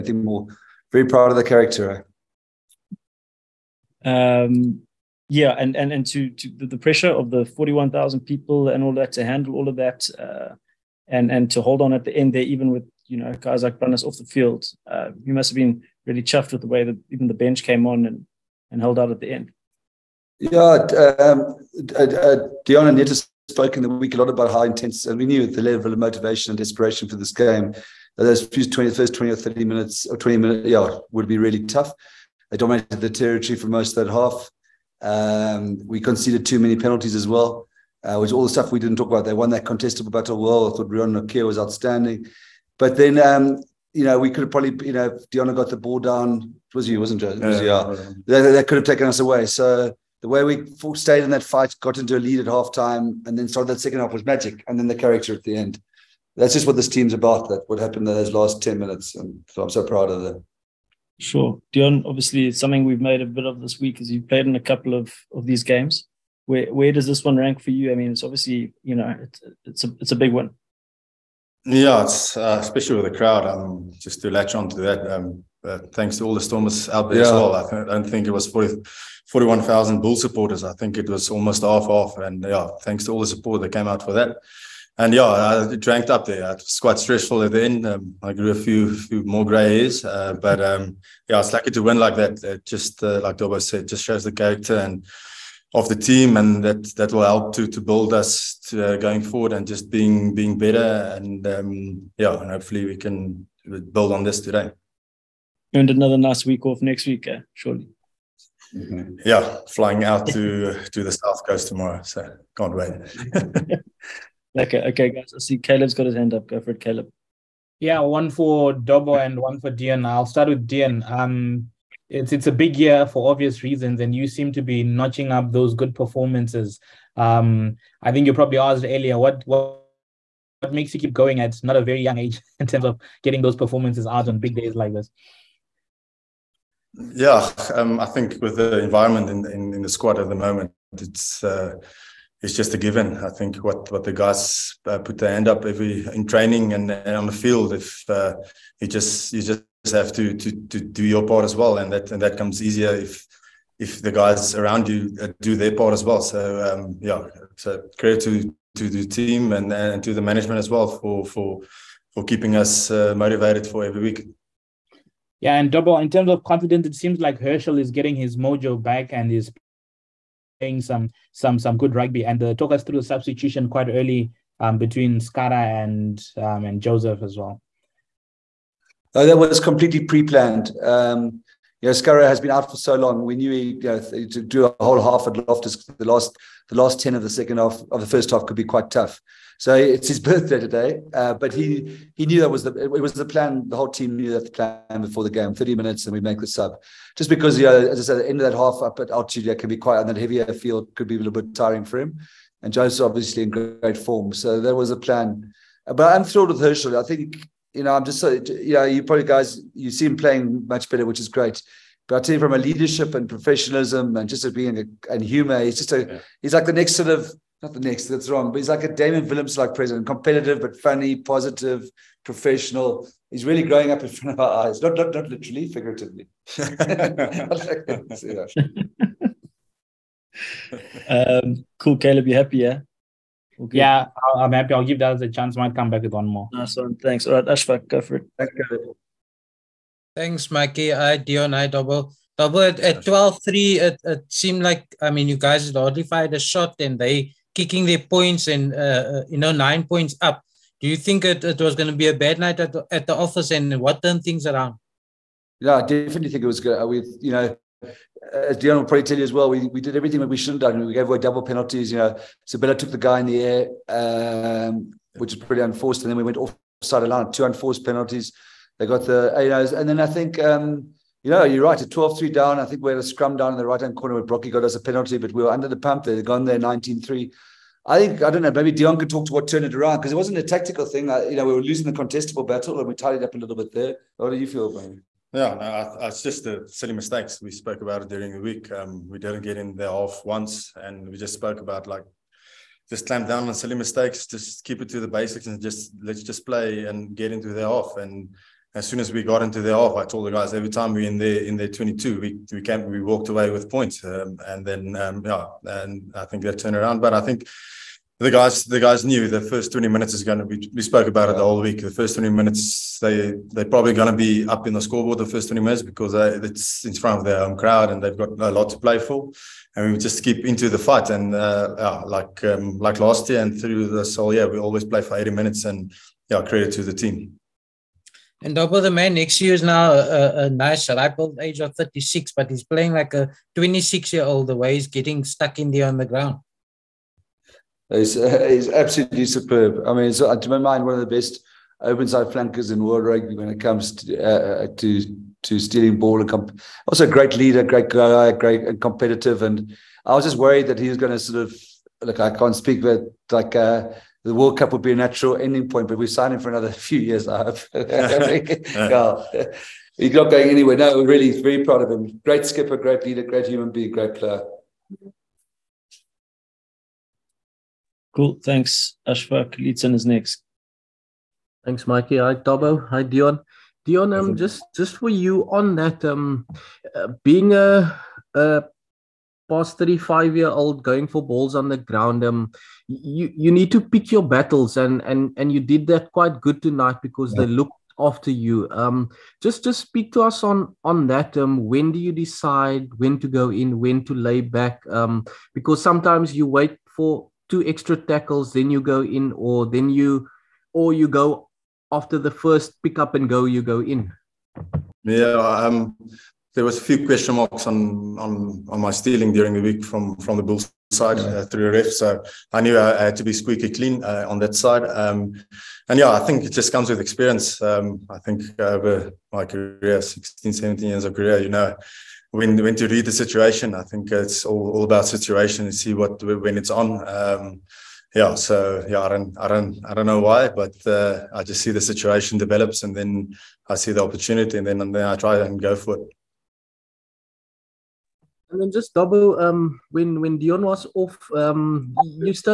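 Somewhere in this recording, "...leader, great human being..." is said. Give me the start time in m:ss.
6:03.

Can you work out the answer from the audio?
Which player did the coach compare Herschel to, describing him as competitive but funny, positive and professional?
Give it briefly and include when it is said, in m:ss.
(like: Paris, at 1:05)
Damian Willemse, at 3:38.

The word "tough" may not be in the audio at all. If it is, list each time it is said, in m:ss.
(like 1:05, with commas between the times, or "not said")
0:31, 3:08.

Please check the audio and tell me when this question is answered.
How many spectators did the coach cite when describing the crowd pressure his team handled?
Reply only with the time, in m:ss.
0:07.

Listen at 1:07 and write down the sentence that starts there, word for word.
I mean, it's obviously you know it's it's a it's a big one.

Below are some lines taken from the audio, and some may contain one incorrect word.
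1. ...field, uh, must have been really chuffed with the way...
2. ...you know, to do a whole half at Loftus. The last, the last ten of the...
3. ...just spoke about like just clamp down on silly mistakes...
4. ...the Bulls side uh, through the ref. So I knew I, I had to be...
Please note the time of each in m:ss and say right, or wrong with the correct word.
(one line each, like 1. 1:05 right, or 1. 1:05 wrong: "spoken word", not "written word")
1. 0:14 right
2. 3:03 right
3. 4:51 right
4. 6:50 right.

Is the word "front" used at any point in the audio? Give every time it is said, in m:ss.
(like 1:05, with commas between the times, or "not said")
3:44, 5:16.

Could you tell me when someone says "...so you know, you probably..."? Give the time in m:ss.
3:28.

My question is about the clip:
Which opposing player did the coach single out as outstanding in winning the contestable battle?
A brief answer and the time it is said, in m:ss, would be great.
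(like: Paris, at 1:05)
Rion Nokia, at 0:40.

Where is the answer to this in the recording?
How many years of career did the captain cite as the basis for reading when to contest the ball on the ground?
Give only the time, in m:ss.
7:00.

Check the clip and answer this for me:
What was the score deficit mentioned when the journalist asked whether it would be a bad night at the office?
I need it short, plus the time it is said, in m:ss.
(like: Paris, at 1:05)
12-3, at 4:03.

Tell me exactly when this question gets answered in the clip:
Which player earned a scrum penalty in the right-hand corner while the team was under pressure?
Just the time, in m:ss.
4:34.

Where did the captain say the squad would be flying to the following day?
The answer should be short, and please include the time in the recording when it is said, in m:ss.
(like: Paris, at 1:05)
The south coast, at 1:51.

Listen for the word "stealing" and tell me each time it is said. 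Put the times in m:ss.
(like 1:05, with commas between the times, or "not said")
5:45, 6:48.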